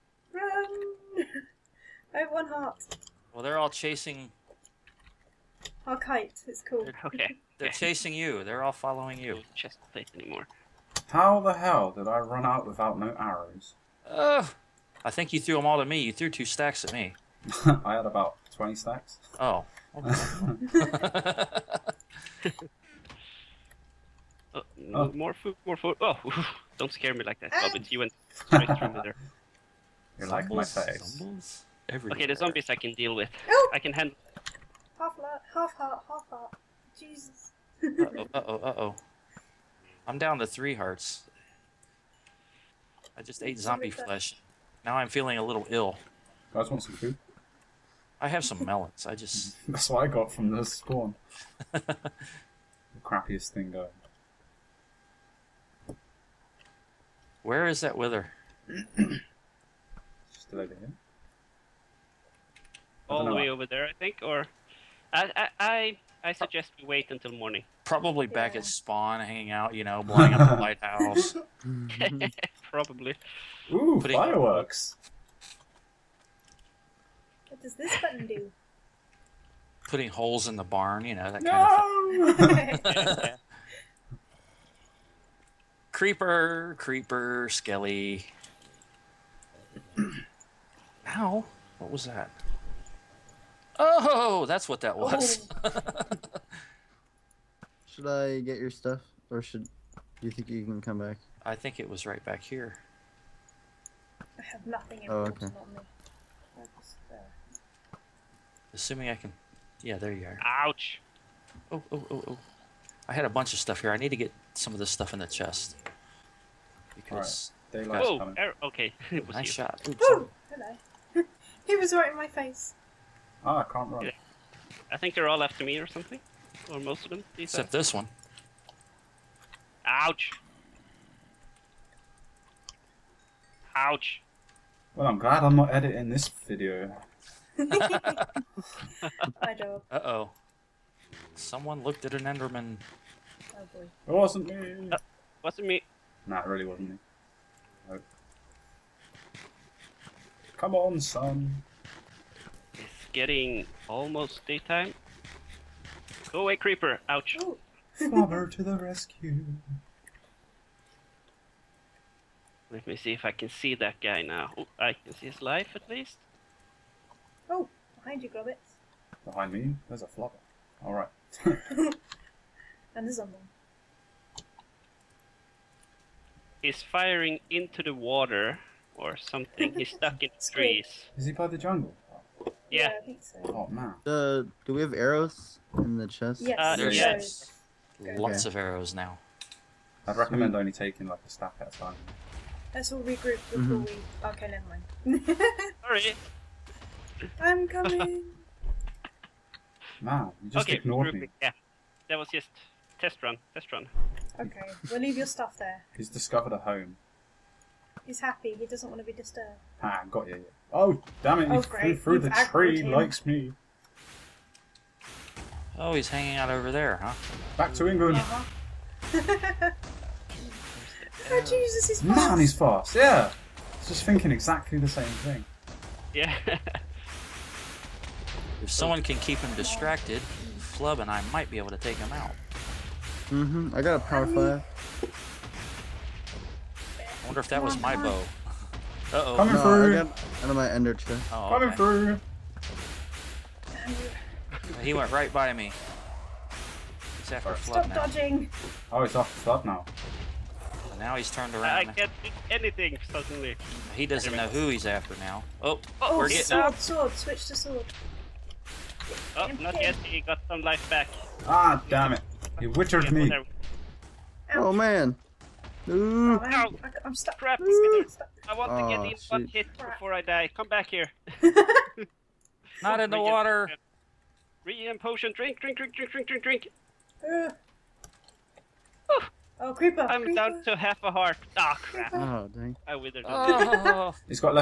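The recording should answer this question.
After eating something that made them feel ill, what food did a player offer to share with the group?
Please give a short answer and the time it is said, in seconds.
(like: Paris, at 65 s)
Melons, at 48 s.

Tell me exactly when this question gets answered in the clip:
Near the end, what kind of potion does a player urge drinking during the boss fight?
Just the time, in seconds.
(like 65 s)
274 s.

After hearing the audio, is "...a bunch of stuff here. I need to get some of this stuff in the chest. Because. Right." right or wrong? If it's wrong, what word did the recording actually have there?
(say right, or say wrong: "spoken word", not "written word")
right.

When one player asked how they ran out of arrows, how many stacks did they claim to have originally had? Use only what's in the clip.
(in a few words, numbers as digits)
20.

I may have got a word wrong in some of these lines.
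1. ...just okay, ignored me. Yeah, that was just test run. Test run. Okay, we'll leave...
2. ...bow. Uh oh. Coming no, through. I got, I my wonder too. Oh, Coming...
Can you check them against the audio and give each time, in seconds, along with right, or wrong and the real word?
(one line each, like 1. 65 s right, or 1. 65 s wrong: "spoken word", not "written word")
1. 200 s right
2. 237 s wrong: "ender", not "wonder".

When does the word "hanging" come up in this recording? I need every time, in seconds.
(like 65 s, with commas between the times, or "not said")
69 s, 216 s.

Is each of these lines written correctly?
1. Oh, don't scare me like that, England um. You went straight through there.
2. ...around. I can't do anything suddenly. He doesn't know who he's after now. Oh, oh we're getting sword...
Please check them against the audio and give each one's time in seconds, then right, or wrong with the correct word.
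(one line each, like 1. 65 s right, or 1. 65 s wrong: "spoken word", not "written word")
1. 26 s wrong: "But", not "England"
2. 251 s right.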